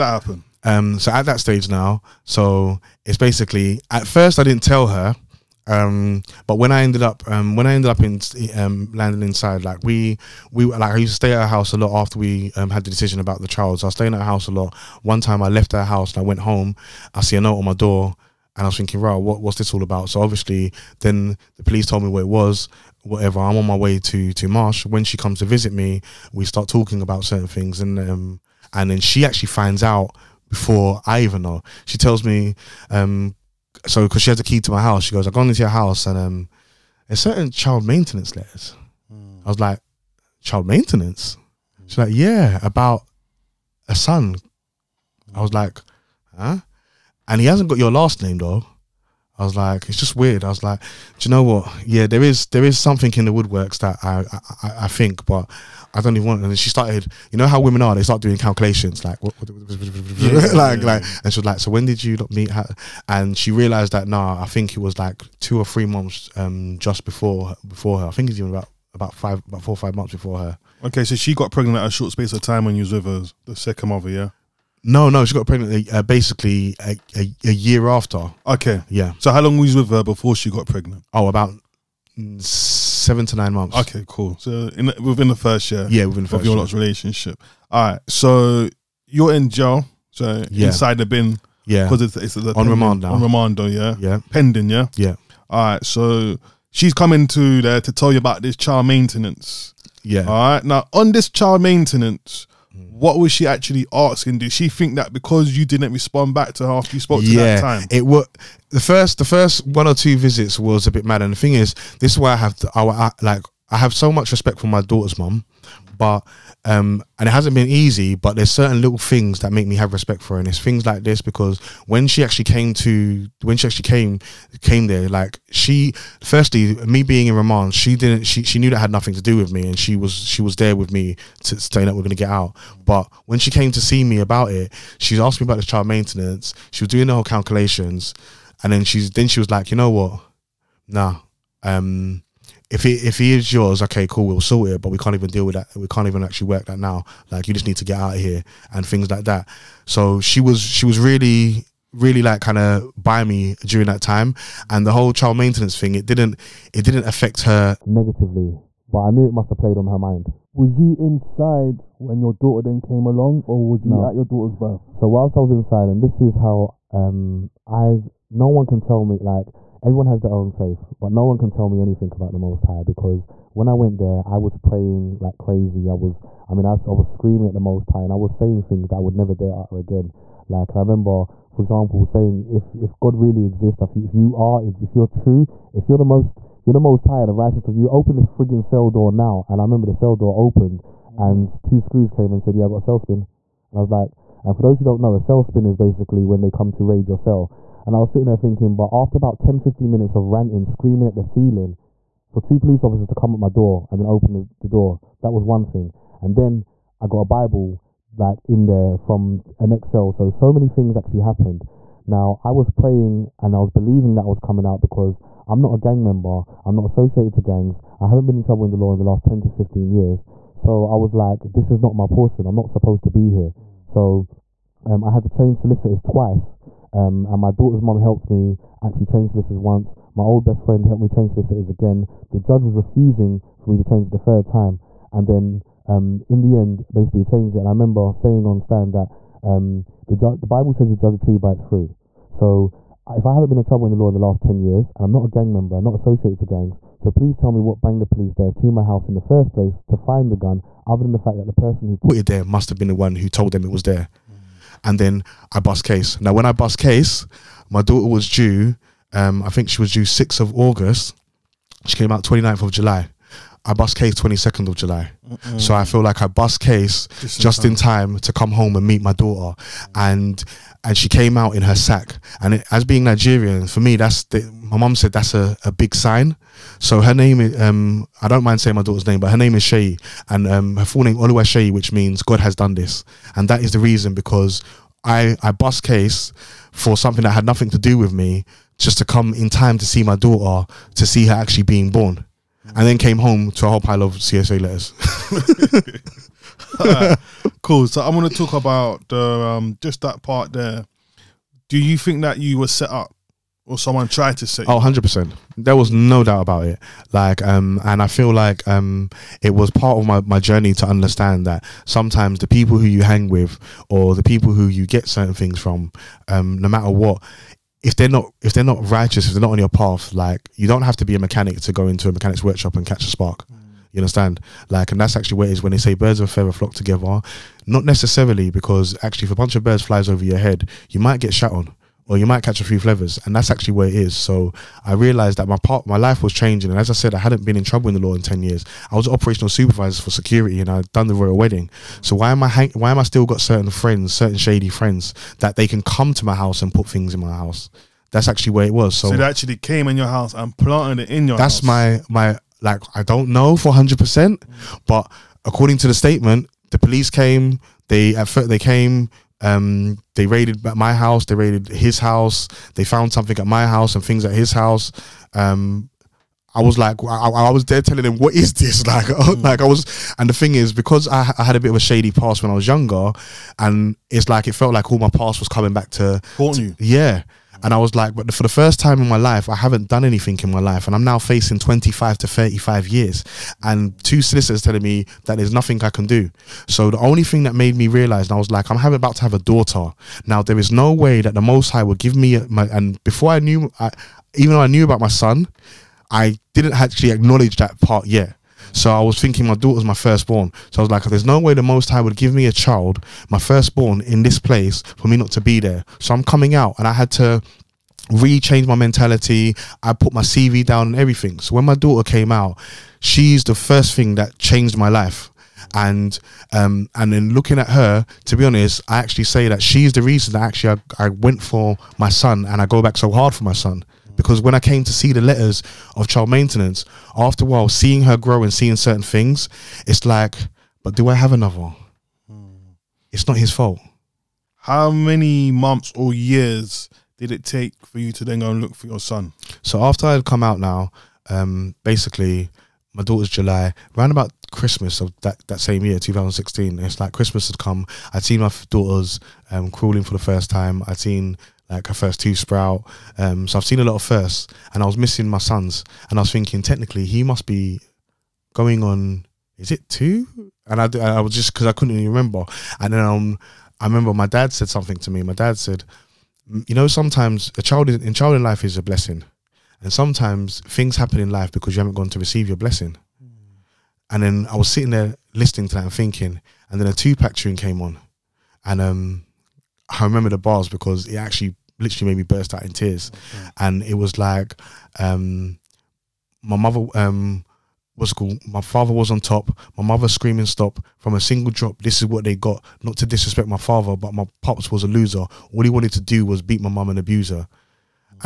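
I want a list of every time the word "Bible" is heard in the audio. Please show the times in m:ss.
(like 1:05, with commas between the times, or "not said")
3:27, 4:00.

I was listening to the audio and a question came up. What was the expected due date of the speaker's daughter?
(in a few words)
6th of August.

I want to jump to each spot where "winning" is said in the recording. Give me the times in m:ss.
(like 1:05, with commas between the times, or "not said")
not said.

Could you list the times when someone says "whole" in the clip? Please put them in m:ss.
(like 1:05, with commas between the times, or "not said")
2:17, 2:34, 4:53.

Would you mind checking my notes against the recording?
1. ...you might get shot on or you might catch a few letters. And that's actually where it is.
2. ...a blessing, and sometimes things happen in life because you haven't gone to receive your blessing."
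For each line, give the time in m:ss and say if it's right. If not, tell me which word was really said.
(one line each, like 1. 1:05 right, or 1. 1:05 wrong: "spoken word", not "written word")
1. 5:30 wrong: "flevers", not "letters"
2. 7:48 right.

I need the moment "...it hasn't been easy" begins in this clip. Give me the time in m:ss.
1:57.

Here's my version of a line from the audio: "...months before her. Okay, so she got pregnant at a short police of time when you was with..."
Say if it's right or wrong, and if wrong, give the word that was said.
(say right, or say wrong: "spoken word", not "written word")
wrong: "space", not "police".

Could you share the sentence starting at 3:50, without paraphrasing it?
My old best friend helped me change solicitors again.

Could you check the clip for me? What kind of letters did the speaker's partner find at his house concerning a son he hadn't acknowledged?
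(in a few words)
Child maintenance letters.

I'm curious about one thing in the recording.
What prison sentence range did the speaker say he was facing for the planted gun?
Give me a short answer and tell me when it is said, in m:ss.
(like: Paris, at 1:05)
25 to 35 years, at 6:21.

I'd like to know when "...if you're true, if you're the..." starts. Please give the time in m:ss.
3:04.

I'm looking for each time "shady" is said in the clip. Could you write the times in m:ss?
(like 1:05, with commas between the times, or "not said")
5:44, 6:11.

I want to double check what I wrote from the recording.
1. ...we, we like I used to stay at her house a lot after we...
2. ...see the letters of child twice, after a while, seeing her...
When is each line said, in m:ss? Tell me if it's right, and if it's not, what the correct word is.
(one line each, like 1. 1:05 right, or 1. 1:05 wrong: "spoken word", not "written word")
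1. 0:09 right
2. 7:04 wrong: "maintenance", not "twice".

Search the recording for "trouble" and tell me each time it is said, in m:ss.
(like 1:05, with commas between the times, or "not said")
3:38, 4:03, 5:37.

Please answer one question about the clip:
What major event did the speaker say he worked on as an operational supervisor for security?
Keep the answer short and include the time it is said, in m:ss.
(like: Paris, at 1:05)
The royal wedding, at 5:41.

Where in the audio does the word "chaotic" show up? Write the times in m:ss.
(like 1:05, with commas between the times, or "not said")
not said.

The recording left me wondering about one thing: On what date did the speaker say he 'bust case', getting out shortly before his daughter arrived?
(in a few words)
22nd of July.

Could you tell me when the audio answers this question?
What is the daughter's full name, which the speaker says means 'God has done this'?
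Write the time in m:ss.
4:41.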